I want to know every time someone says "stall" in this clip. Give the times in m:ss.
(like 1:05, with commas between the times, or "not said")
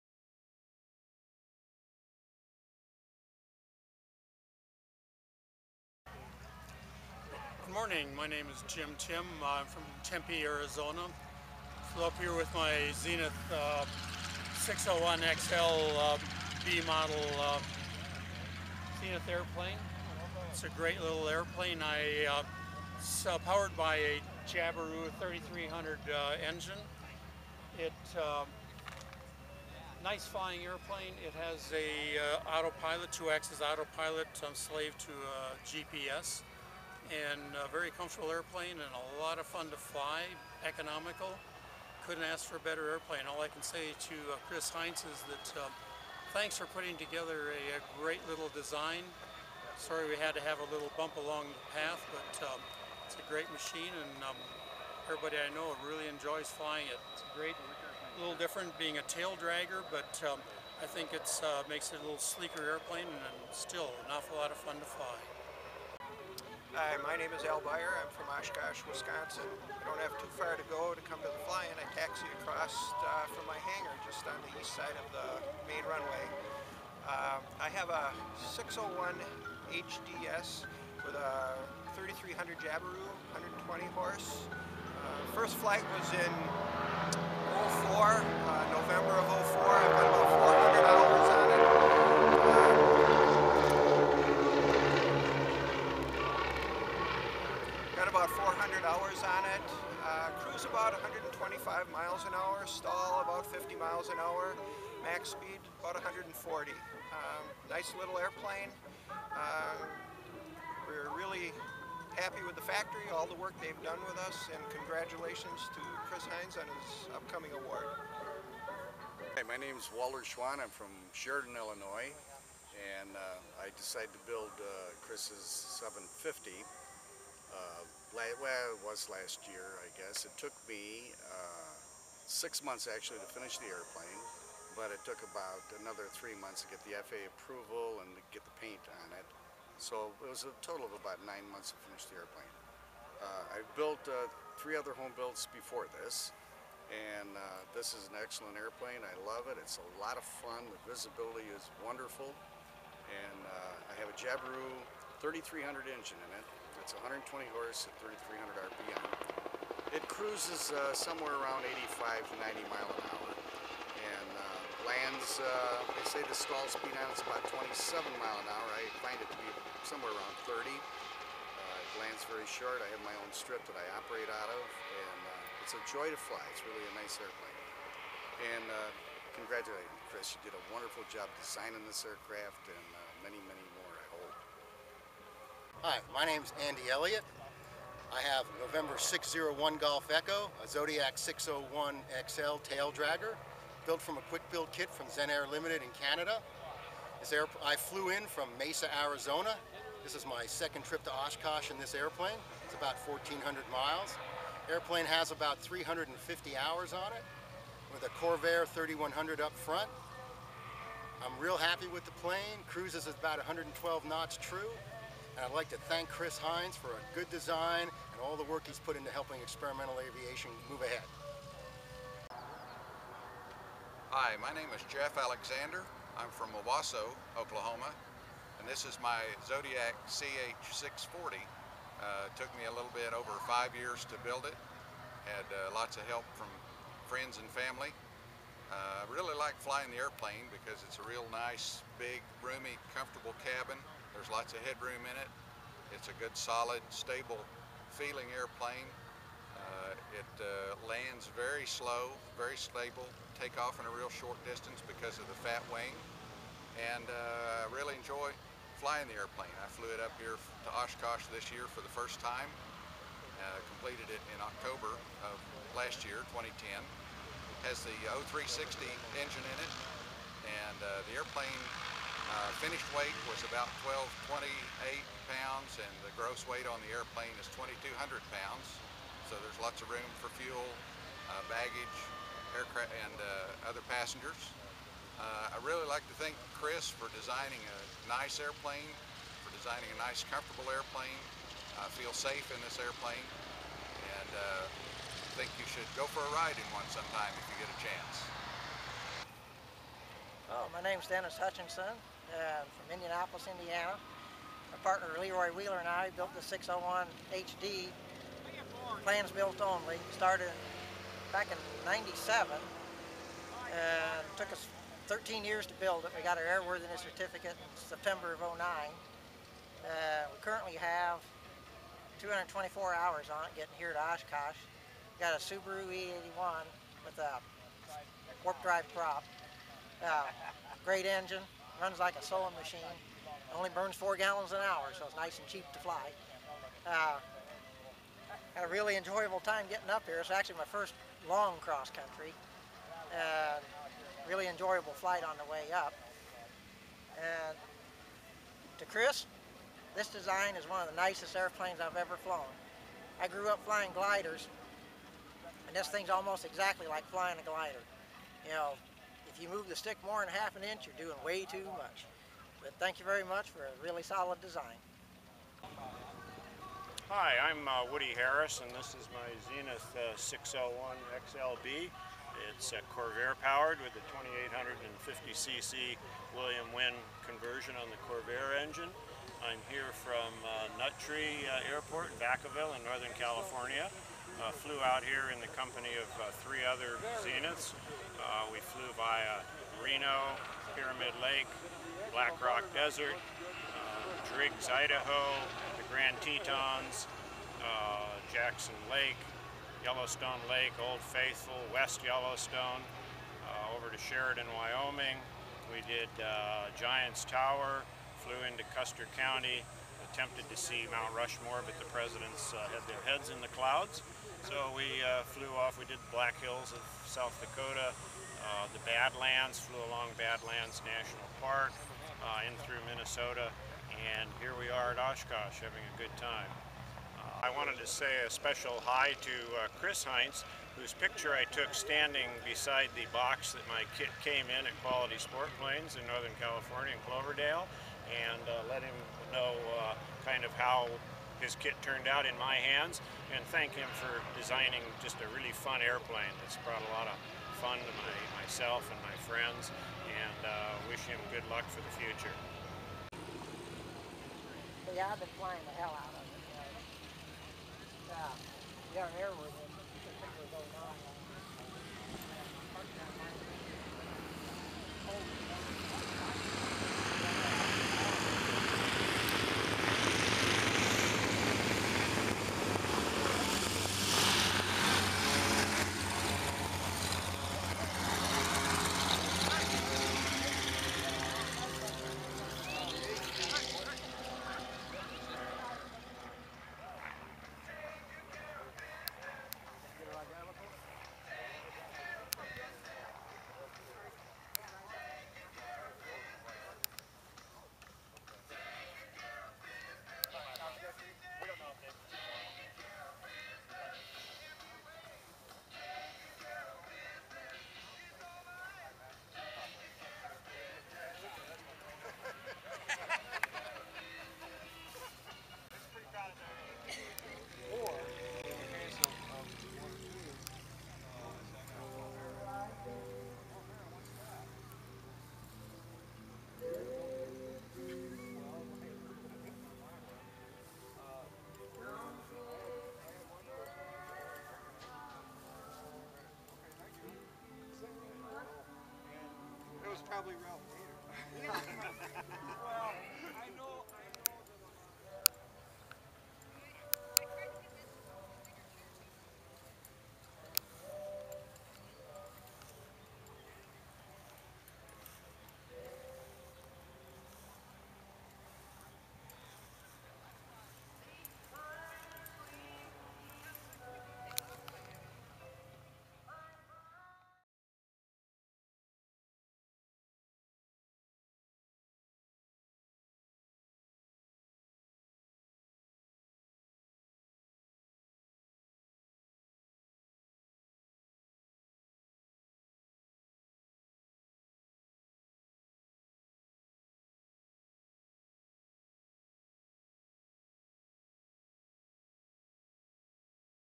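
1:42, 2:46.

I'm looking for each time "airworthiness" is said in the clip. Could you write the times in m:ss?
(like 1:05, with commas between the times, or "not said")
5:16, 7:39.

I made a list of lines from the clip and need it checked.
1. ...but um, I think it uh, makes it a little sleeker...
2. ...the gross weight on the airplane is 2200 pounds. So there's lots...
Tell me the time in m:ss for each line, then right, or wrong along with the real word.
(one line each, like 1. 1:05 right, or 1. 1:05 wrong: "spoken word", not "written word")
1. 0:59 right
2. 4:36 right.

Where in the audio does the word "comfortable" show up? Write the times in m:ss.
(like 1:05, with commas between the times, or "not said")
0:37, 4:02, 4:50.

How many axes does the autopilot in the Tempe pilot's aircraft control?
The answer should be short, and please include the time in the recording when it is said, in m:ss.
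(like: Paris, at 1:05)
2, at 0:33.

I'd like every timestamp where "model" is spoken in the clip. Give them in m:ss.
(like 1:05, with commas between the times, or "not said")
0:16.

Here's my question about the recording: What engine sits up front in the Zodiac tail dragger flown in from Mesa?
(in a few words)
Corvair 3100.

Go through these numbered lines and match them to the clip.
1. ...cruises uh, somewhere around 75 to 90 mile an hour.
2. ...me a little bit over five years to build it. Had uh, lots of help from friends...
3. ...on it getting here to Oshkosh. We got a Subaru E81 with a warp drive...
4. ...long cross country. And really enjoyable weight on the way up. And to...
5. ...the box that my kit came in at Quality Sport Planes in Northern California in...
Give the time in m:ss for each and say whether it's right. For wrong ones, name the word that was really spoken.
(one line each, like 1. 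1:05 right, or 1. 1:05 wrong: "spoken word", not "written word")
1. 2:40 wrong: "85", not "75"
2. 3:52 right
3. 5:23 right
4. 5:41 wrong: "flight", not "weight"
5. 7:12 right.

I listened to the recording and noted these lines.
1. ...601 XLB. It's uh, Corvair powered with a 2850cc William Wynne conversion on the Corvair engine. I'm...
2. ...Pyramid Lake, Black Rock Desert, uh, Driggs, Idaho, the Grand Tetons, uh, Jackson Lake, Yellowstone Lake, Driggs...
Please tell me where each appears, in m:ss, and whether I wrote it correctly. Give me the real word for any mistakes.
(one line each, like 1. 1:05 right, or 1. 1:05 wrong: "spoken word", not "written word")
1. 6:10 right
2. 6:30 wrong: "Old", not "Driggs".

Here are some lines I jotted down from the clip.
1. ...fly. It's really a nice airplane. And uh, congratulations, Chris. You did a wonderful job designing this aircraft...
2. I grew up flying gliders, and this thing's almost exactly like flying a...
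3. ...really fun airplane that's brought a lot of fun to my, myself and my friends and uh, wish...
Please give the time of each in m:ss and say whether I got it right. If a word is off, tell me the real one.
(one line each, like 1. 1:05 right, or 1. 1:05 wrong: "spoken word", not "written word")
1. 2:56 right
2. 5:53 right
3. 7:25 right.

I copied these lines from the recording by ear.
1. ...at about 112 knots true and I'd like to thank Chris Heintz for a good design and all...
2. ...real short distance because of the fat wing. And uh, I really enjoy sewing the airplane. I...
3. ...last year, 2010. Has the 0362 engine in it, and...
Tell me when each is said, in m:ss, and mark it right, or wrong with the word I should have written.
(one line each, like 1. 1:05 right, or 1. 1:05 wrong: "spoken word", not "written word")
1. 3:33 right
2. 4:13 wrong: "flying", not "sewing"
3. 4:25 wrong: "0360", not "0362".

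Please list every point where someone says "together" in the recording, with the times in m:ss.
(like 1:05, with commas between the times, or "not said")
0:46.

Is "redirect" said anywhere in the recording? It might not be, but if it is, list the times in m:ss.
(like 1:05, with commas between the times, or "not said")
not said.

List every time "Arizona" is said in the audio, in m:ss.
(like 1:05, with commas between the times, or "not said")
0:10, 3:19.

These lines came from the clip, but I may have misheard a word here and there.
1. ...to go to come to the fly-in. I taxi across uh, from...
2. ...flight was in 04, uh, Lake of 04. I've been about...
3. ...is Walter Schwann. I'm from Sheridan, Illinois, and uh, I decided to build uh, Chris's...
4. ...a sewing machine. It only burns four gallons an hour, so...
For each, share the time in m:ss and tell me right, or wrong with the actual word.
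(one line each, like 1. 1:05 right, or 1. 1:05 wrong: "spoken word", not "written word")
1. 1:10 right
2. 1:25 wrong: "November", not "Lake"
3. 1:59 right
4. 5:32 right.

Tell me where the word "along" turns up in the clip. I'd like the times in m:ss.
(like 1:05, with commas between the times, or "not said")
0:51, 6:59.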